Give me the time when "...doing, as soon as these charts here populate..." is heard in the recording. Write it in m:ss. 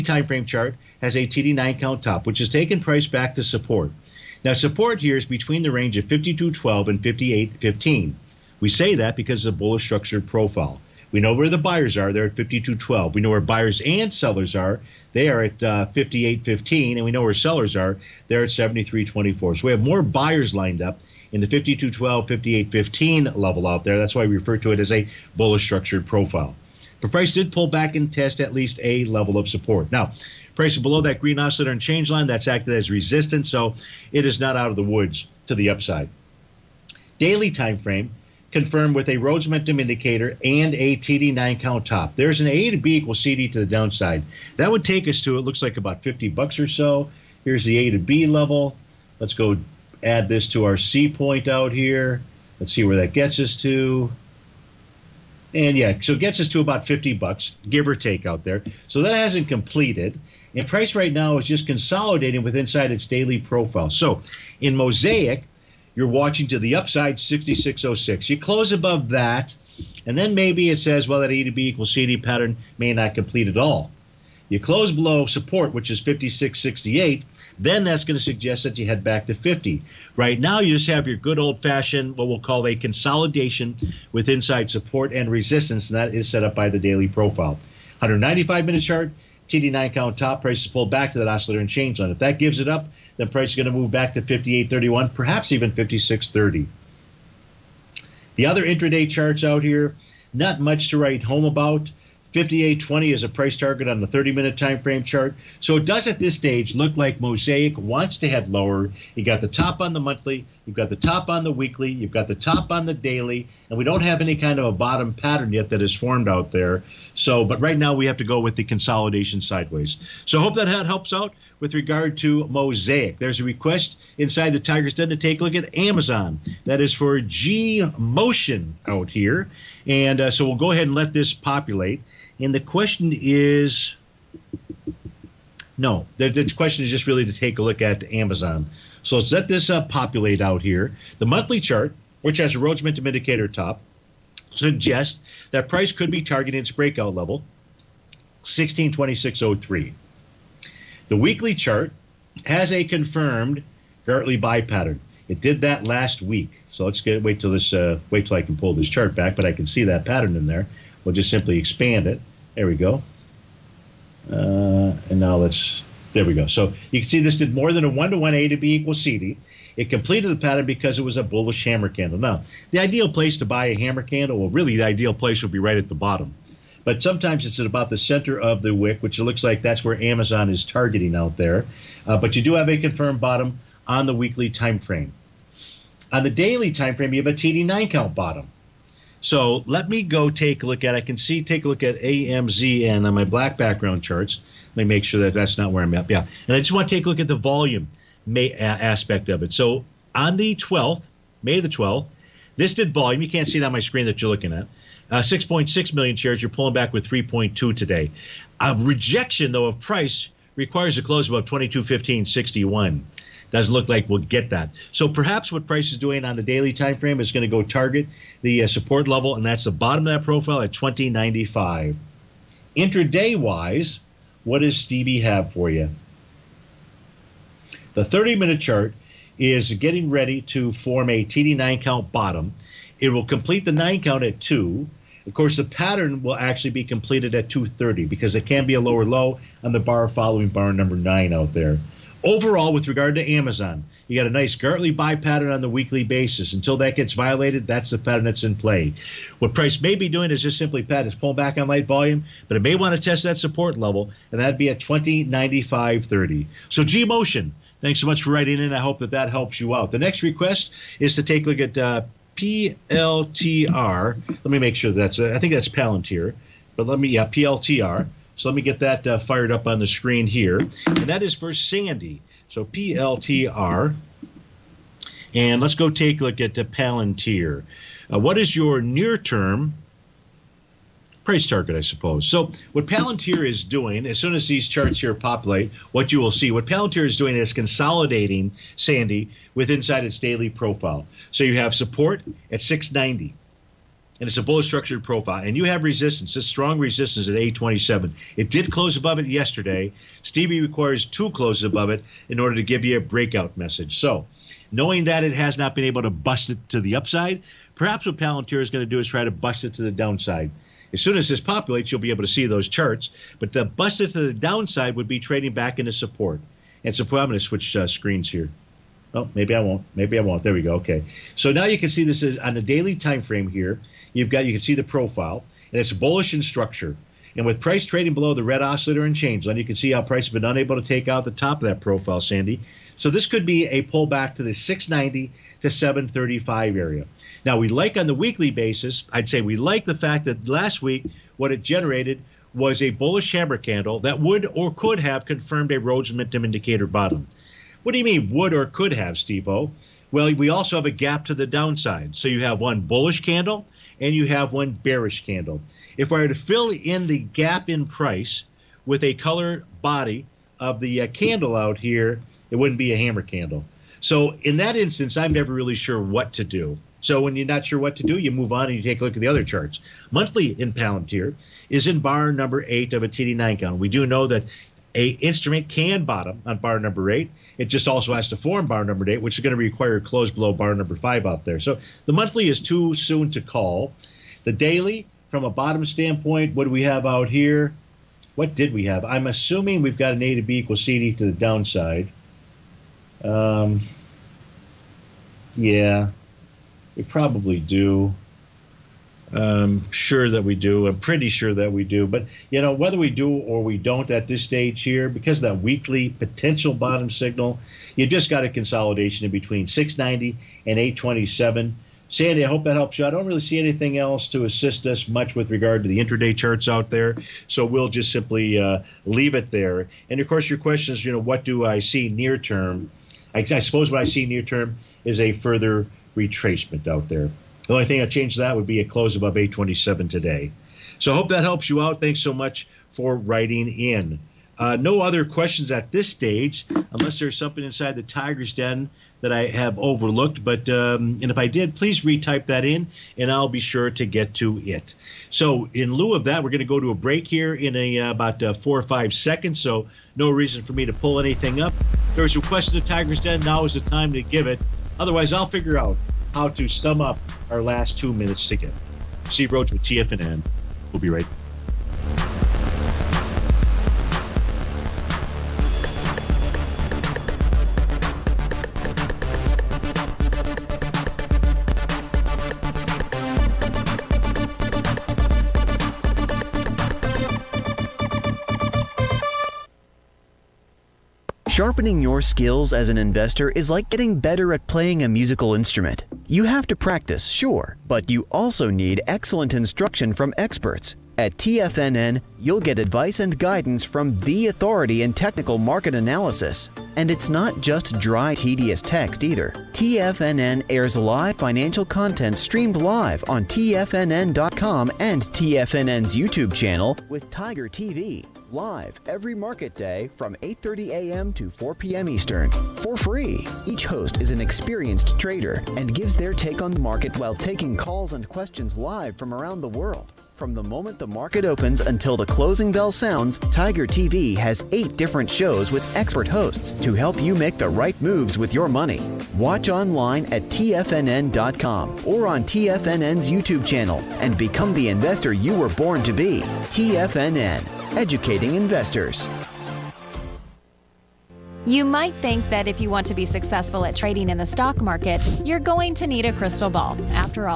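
4:43.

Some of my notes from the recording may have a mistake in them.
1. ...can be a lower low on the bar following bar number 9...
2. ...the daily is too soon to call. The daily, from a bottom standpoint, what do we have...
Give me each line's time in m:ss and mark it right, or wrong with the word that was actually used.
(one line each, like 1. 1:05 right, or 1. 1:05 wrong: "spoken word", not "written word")
1. 3:58 right
2. 6:22 wrong: "monthly", not "daily".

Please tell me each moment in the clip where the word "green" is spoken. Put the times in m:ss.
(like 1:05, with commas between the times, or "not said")
0:31.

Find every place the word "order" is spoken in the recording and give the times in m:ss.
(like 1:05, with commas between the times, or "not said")
5:02.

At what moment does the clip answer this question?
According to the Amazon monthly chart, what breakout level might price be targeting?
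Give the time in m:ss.
2:28.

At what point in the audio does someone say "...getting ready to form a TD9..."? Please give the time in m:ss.
3:49.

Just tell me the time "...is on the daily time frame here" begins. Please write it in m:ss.
5:22.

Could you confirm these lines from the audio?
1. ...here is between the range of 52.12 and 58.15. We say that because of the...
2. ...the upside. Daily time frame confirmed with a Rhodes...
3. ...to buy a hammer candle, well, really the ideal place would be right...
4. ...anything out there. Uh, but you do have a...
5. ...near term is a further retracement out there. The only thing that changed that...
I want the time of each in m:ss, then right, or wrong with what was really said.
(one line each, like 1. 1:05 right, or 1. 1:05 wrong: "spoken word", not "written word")
1. 0:05 right
2. 0:35 right
3. 2:53 right
4. 3:00 wrong: "targeting", not "anything"
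5. 7:04 right.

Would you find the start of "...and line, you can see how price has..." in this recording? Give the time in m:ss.
5:29.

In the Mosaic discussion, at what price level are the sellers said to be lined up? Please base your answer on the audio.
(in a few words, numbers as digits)
73.24.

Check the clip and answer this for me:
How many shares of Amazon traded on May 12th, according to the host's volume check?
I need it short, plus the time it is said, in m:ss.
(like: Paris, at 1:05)
6.6 million, at 3:25.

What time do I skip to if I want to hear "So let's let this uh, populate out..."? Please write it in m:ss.
2:19.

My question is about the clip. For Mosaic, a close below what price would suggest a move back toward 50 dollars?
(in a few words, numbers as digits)
56.68.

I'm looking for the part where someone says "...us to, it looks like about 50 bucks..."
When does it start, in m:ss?
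0:45.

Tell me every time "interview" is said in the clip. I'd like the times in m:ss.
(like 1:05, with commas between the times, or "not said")
not said.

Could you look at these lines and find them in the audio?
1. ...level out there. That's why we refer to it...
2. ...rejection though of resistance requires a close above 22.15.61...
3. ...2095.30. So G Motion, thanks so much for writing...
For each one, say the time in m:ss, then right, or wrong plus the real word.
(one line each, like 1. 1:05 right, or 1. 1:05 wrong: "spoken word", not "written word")
1. 0:23 right
2. 3:28 wrong: "price", not "resistance"
3. 4:14 right.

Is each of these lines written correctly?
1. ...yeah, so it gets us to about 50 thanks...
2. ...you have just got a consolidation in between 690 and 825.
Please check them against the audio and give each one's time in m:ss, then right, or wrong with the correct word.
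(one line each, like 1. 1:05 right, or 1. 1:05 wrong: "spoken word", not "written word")
1. 0:55 wrong: "bucks", not "thanks"
2. 6:47 wrong: "827", not "825".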